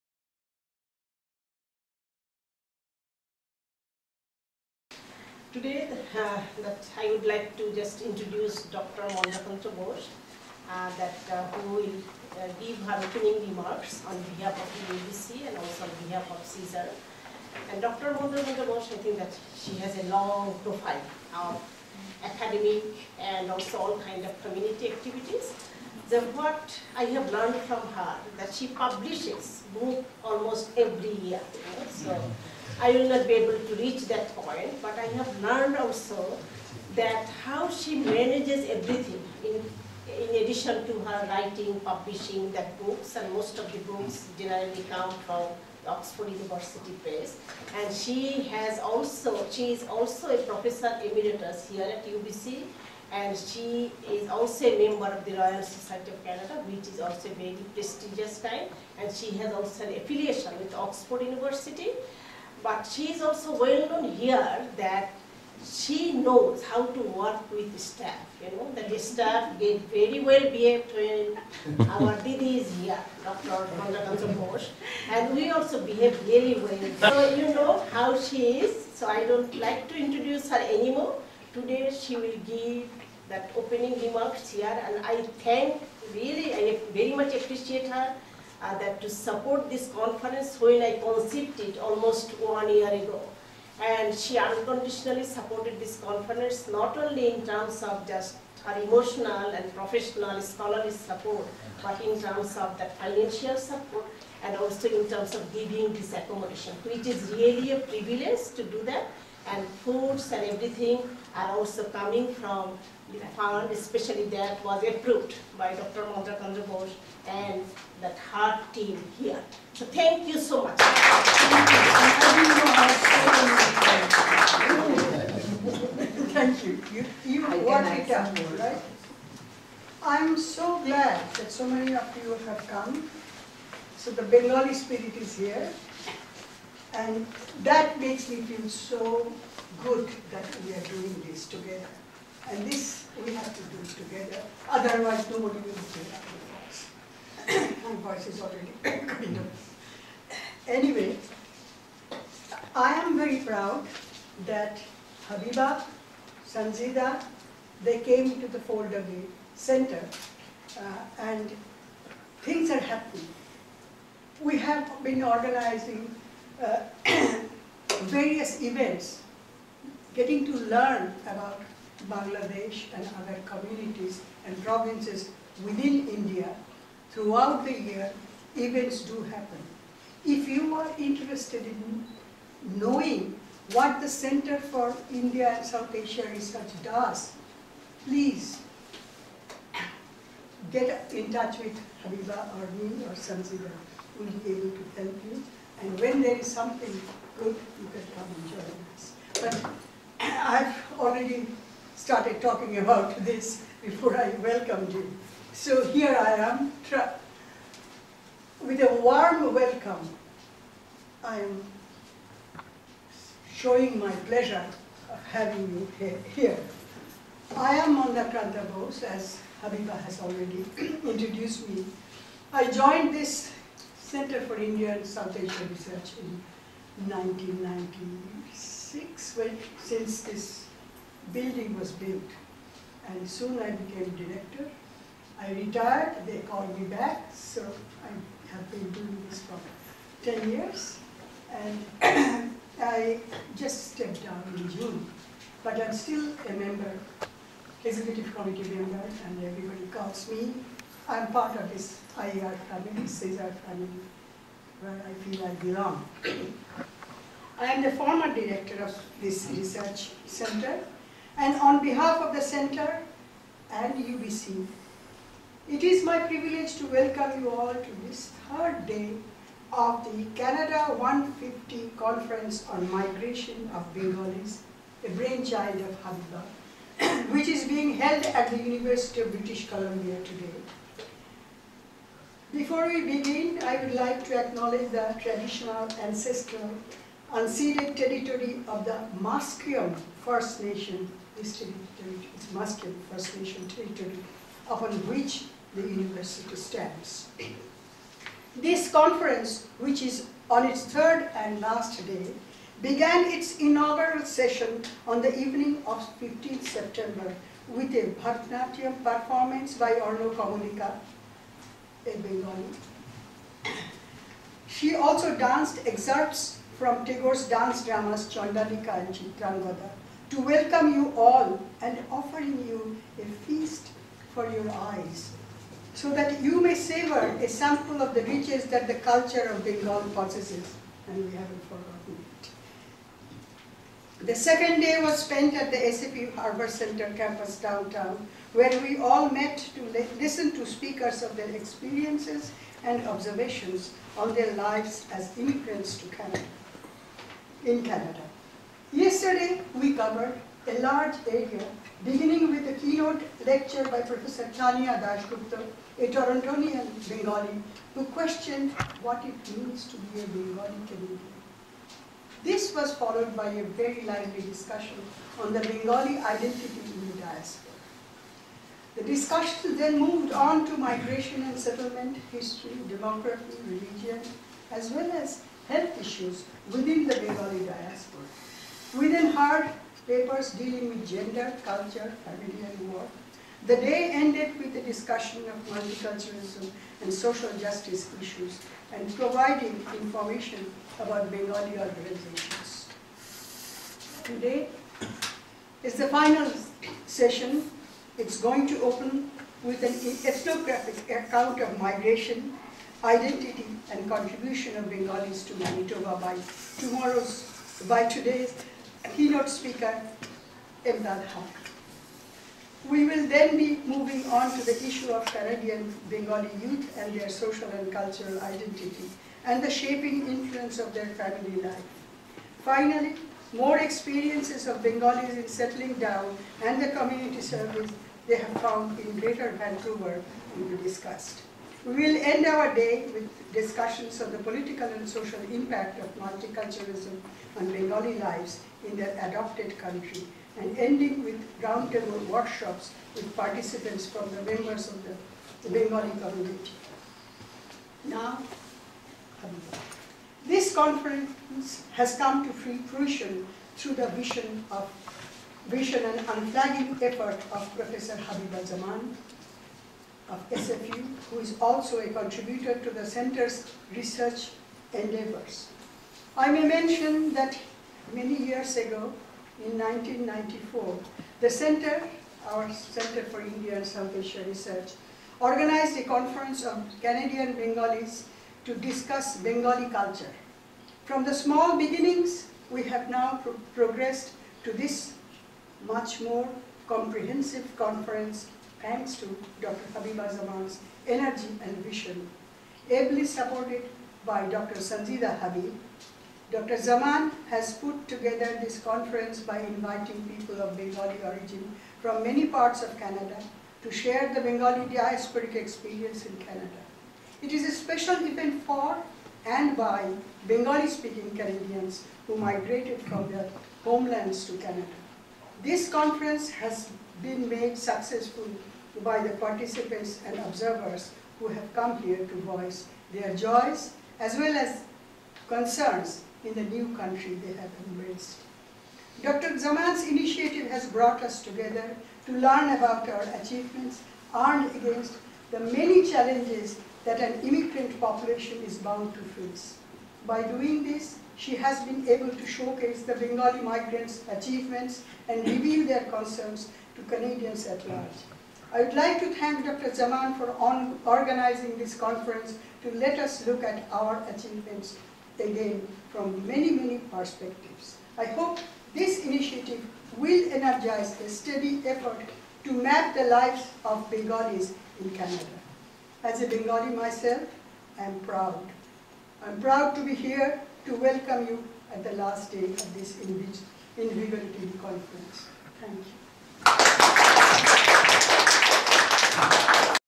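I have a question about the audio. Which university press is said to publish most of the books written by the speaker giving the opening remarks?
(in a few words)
Oxford University Press.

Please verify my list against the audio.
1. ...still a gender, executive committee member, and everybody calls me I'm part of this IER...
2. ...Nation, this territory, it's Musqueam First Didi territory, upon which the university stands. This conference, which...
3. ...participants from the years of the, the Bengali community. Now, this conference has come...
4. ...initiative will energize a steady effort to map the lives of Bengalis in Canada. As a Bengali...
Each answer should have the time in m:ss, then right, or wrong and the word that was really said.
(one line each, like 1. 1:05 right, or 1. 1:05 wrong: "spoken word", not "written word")
1. 4:05 wrong: "member", not "gender"
2. 4:50 wrong: "Nation", not "Didi"
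3. 7:23 wrong: "members", not "years"
4. 9:19 right.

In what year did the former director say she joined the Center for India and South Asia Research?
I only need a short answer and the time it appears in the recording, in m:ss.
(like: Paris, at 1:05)
1996, at 3:47.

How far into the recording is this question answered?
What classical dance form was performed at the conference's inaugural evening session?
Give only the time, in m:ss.
5:08.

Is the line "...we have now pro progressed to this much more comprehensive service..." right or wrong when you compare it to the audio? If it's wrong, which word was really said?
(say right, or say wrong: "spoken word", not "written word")
wrong: "conference", not "service".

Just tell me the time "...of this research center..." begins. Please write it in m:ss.
4:18.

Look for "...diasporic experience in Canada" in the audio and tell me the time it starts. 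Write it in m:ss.
8:24.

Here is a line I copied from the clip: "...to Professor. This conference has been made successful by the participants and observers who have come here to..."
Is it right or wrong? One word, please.
wrong.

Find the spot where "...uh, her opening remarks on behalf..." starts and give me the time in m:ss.
0:12.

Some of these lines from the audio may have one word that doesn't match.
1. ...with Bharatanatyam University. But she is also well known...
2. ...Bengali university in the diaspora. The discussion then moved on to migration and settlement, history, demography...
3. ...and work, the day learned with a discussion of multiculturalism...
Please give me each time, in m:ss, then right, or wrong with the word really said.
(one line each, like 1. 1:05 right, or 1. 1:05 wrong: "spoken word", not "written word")
1. 1:00 wrong: "Oxford", not "Bharatanatyam"
2. 6:05 wrong: "identity", not "university"
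3. 6:22 wrong: "ended", not "learned".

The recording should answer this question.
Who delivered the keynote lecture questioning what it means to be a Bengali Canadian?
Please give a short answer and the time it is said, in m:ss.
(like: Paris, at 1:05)
Tania Das Gupta, at 5:54.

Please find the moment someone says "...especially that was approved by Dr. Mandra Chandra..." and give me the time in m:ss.
1:53.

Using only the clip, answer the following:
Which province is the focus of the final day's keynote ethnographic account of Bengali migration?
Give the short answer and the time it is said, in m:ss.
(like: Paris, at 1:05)
Manitoba, at 6:45.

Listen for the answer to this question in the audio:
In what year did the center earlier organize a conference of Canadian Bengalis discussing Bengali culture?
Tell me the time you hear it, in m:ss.
7:49.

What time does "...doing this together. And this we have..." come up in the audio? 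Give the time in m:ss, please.
2:20.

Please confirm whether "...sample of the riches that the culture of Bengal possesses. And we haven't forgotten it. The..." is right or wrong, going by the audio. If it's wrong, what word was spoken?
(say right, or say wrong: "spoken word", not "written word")
right.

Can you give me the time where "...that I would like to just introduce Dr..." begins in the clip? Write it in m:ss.
0:06.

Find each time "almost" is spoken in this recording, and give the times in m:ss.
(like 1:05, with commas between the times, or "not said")
0:30, 1:31.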